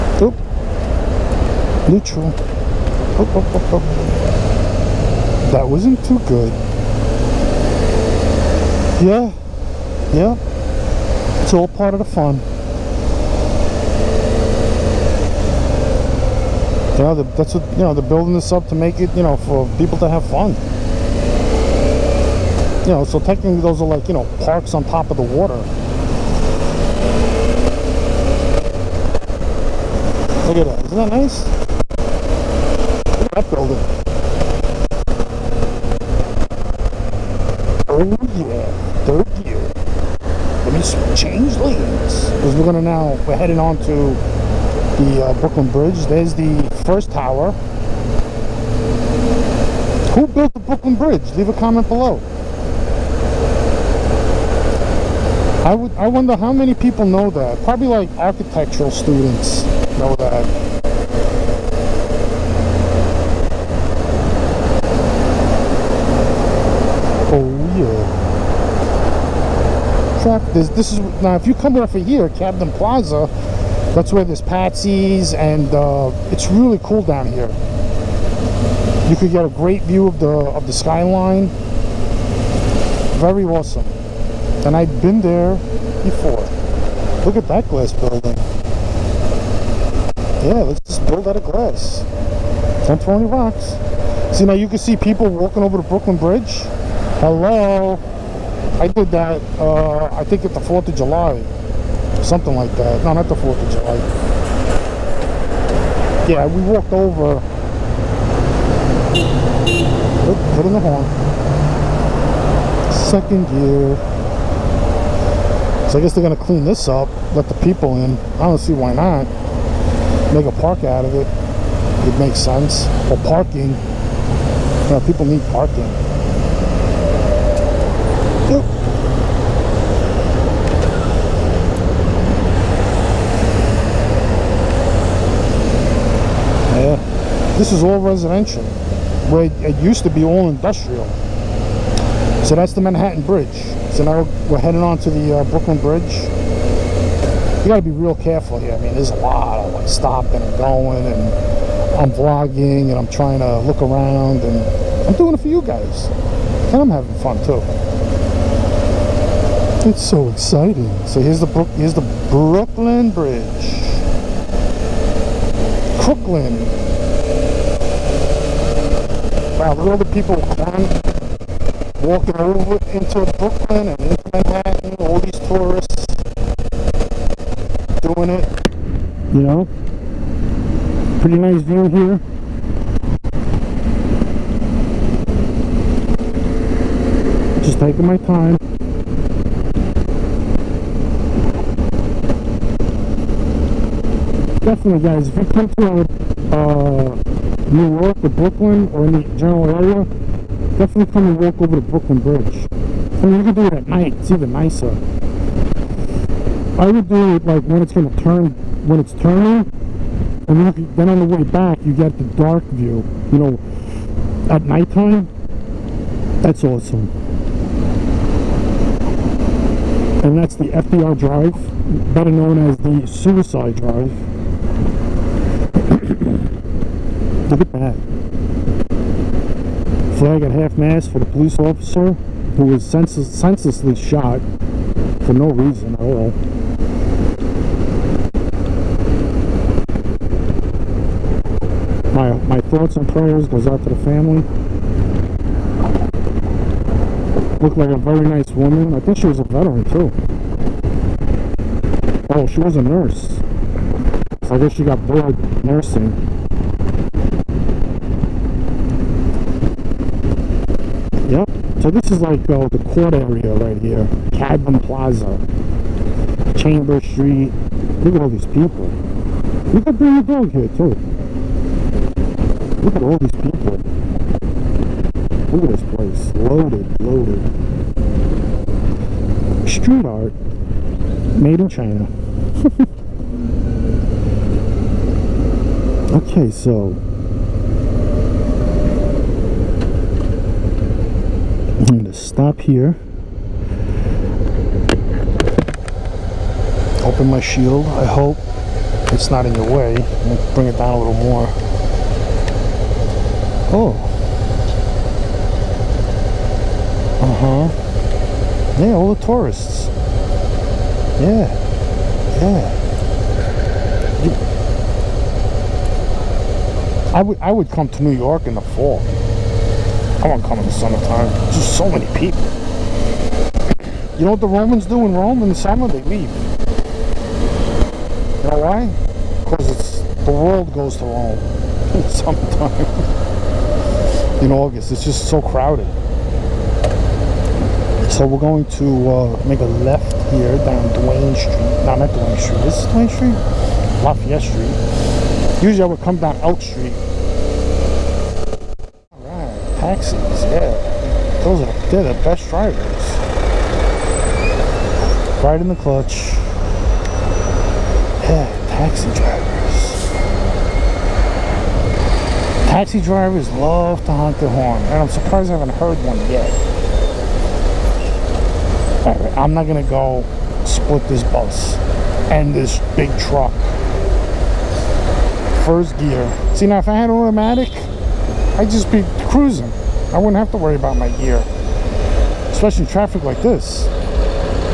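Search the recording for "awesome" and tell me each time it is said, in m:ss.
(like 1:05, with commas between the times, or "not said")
1:23, 3:36.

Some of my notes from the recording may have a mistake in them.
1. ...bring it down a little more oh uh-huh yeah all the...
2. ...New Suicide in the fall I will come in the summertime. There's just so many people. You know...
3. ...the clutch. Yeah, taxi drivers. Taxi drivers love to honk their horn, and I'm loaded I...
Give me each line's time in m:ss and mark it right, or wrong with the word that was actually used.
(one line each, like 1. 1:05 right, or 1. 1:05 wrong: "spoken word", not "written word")
1. 5:00 right
2. 5:18 wrong: "York", not "Suicide"
3. 5:55 wrong: "surprised", not "loaded".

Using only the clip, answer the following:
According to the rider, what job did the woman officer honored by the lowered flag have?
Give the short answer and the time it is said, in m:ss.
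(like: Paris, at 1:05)
nurse, at 4:12.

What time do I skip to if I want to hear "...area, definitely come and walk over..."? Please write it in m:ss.
3:19.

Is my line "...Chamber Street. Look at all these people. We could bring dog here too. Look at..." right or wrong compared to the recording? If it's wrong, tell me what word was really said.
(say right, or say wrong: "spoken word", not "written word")
right.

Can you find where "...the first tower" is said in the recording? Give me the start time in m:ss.
0:46.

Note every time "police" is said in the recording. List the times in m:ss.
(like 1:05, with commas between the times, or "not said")
3:51.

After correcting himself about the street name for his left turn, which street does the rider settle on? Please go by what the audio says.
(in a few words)
Lafayette Street.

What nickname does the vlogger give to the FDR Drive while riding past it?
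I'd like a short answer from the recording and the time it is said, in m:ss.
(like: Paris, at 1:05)
Suicide Drive, at 3:42.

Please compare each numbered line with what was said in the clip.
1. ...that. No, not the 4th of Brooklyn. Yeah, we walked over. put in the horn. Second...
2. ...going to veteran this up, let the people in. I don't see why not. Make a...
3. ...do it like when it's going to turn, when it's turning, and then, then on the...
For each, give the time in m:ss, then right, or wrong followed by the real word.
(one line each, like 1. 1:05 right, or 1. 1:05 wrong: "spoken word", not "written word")
1. 1:42 wrong: "July", not "Brooklyn"
2. 1:56 wrong: "clean", not "veteran"
3. 3:27 right.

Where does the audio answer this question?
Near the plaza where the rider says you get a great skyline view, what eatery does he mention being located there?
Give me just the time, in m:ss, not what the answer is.
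1:14.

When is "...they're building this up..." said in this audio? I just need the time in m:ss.
0:17.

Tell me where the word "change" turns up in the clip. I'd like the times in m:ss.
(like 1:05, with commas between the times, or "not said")
0:41.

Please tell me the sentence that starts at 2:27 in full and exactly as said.
You gotta be real careful here.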